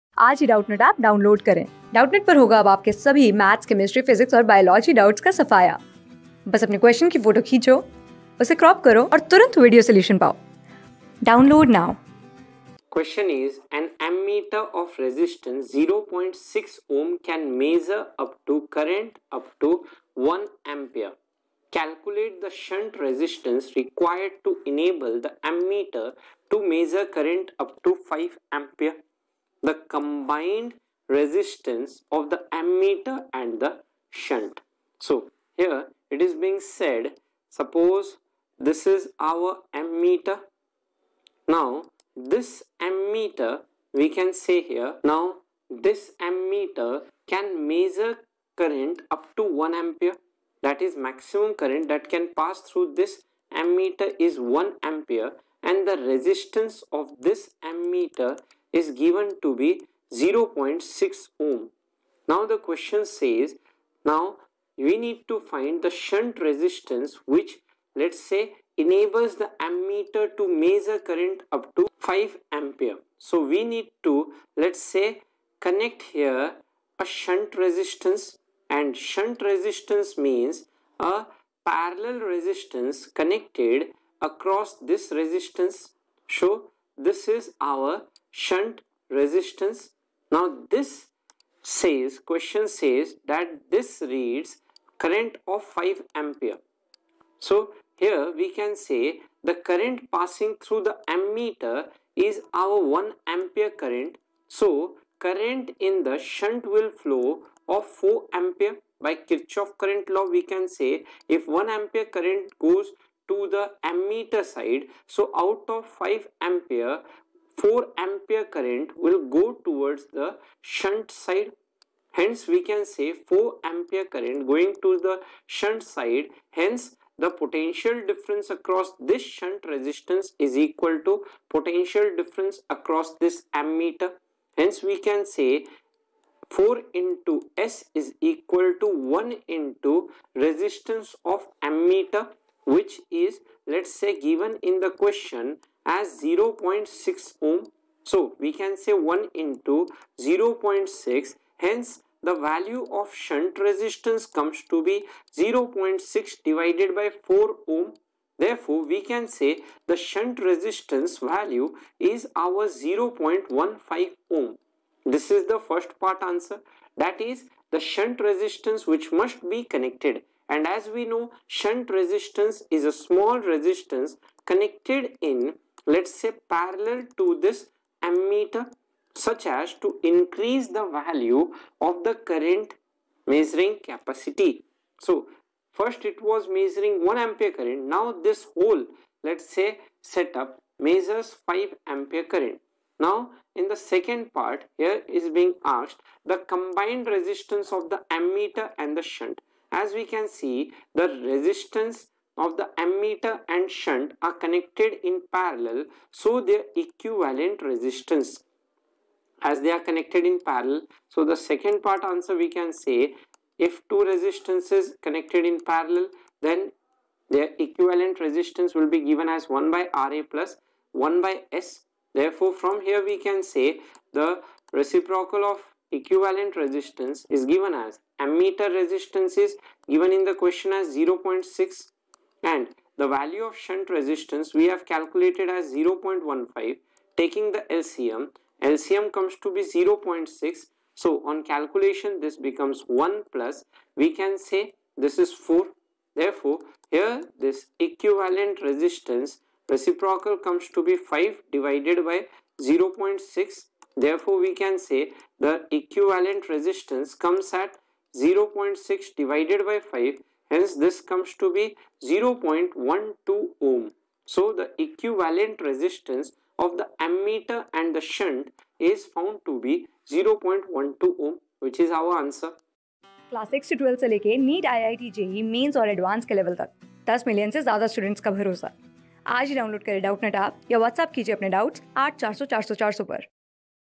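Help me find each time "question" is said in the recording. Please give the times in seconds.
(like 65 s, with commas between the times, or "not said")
12 s, 62 s, 92 s, 144 s, 230 s.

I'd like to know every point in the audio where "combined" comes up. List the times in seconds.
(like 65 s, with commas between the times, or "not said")
29 s, 196 s.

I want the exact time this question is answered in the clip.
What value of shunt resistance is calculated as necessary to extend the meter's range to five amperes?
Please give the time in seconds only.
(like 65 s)
162 s.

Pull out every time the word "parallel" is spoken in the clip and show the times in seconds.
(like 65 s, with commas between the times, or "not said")
81 s, 176 s, 205 s, 210 s, 215 s.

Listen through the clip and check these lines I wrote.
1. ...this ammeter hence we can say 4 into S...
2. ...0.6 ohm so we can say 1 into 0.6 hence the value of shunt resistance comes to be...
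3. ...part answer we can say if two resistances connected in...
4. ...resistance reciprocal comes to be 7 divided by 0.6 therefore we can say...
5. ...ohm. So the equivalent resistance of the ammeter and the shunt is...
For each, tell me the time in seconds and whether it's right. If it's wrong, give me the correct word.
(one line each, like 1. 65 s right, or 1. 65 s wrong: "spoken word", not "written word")
1. 133 s right
2. 146 s right
3. 211 s right
4. 248 s wrong: "5", not "7"
5. 263 s right.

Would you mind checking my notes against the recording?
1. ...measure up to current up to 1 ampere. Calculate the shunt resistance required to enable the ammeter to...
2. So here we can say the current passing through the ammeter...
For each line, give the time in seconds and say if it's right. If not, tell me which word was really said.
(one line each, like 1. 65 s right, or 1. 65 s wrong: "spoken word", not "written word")
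1. 17 s right
2. 97 s right.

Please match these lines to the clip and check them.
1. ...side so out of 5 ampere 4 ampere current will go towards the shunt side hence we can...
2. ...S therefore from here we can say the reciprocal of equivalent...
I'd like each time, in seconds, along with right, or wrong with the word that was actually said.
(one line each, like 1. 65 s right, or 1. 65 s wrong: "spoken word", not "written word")
1. 114 s right
2. 221 s right.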